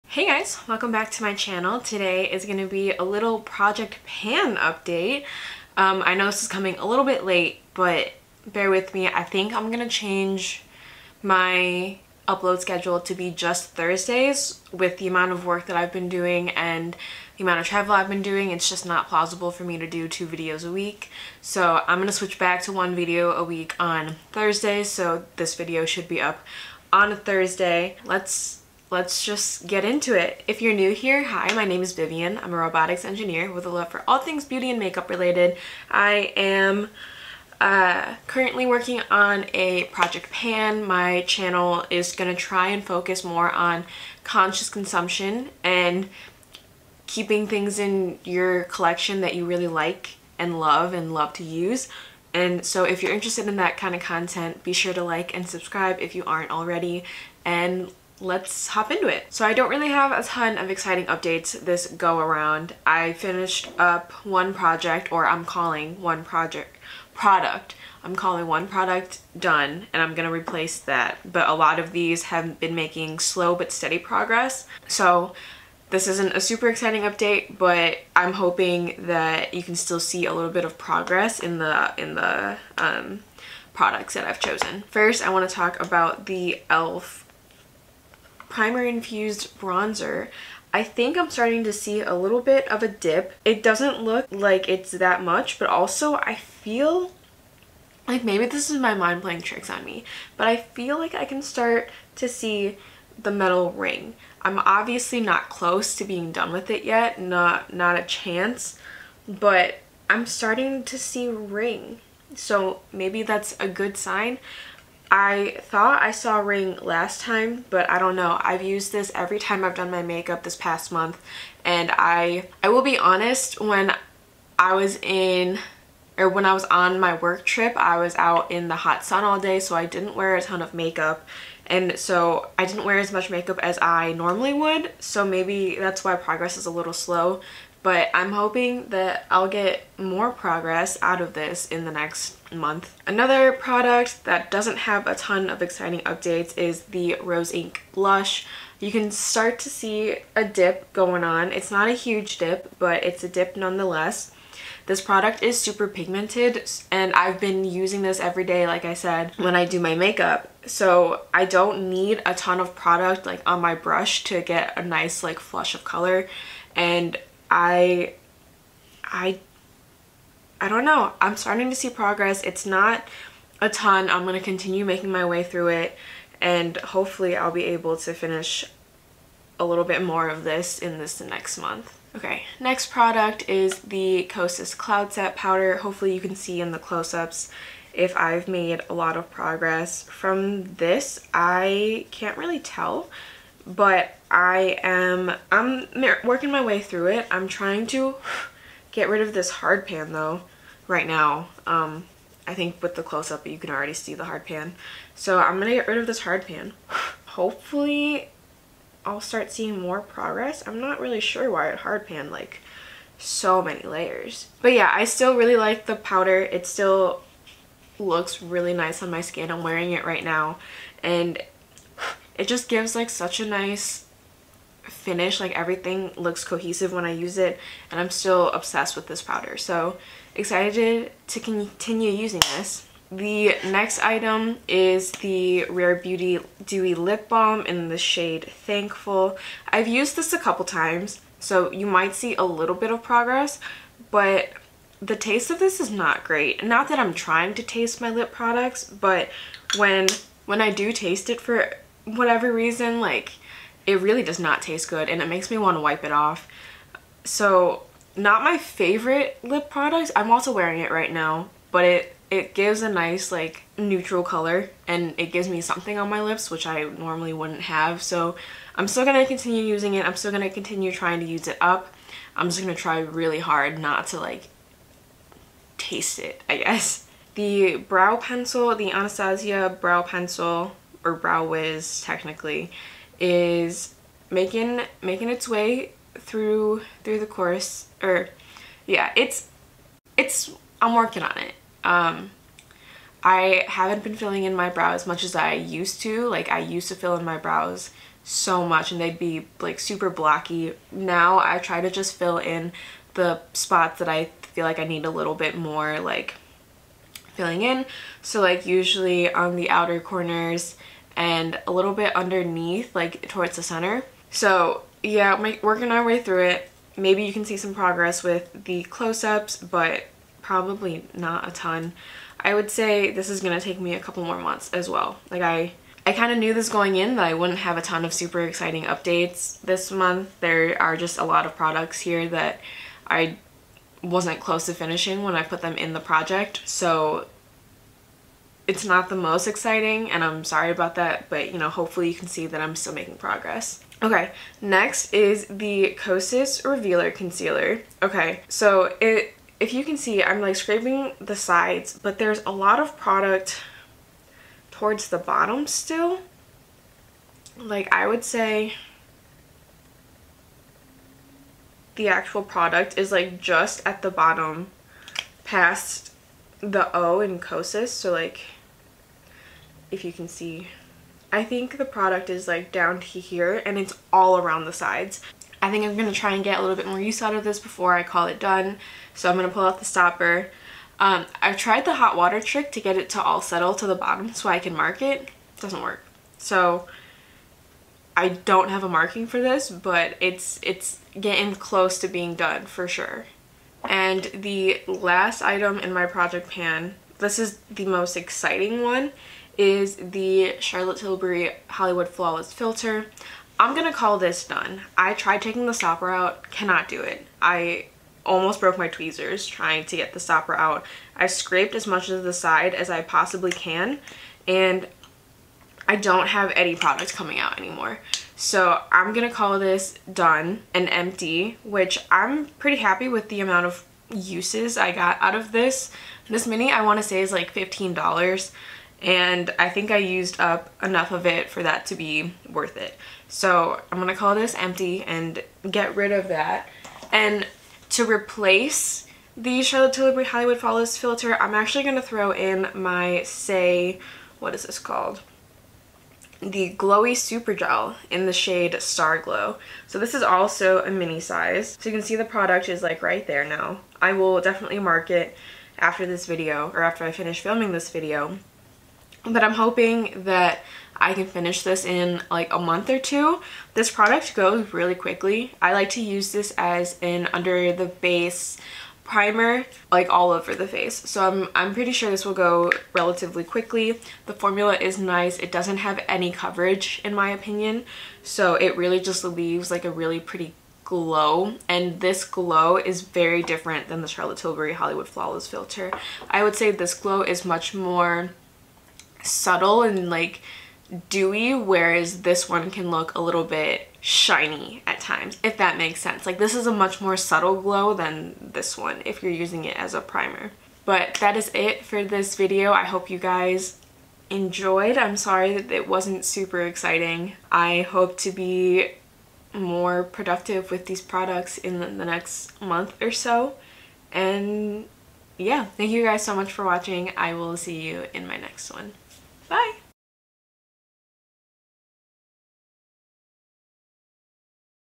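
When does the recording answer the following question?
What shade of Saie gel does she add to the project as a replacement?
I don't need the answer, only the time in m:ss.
7:28.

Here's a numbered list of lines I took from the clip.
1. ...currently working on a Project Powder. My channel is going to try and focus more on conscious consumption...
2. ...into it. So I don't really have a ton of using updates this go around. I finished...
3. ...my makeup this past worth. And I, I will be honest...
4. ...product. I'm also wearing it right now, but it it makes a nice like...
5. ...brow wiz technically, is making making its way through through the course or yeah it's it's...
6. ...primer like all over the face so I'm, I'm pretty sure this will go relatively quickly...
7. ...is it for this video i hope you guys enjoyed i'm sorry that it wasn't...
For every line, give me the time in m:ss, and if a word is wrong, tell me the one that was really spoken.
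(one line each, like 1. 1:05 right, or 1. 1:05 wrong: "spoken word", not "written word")
1. 0:38 wrong: "Pan", not "Powder"
2. 0:58 wrong: "exciting", not "using"
3. 1:59 wrong: "month", not "worth"
4. 4:19 wrong: "gives", not "makes"
5. 4:41 right
6. 7:49 right
7. 8:21 right.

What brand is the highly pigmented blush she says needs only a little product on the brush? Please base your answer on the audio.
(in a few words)
Rose Inc.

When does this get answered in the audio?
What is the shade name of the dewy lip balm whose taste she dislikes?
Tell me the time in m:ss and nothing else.
3:58.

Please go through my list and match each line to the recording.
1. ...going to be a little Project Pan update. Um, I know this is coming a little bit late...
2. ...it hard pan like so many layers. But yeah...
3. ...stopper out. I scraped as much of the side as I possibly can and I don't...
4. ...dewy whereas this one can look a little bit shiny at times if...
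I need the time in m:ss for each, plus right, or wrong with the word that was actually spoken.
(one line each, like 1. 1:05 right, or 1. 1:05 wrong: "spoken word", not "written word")
1. 0:02 right
2. 3:31 right
3. 6:50 right
4. 8:11 right.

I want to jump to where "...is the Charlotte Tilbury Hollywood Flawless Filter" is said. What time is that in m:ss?
6:39.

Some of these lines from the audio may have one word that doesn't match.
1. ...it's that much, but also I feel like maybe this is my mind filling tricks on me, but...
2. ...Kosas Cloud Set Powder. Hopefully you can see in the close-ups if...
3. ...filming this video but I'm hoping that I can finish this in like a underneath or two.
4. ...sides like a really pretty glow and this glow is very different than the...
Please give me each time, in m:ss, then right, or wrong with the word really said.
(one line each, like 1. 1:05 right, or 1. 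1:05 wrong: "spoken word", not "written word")
1. 1:34 wrong: "playing", not "filling"
2. 3:04 right
3. 7:37 wrong: "month", not "underneath"
4. 7:59 wrong: "leaves", not "sides".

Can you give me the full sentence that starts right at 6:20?
Um, I've tried the hot water trick to get it to all settle to the bottom so I can mark it.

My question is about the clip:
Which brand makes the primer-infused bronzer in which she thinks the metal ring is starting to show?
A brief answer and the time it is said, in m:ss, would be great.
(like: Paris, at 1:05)
e.l.f, at 1:26.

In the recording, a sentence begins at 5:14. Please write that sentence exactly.
So yeah, my, working our way through it.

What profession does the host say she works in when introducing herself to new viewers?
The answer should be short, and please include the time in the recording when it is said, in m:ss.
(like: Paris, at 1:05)
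robotics engineer, at 0:32.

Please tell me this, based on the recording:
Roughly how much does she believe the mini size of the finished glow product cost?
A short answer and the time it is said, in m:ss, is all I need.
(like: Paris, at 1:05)
$15, at 7:07.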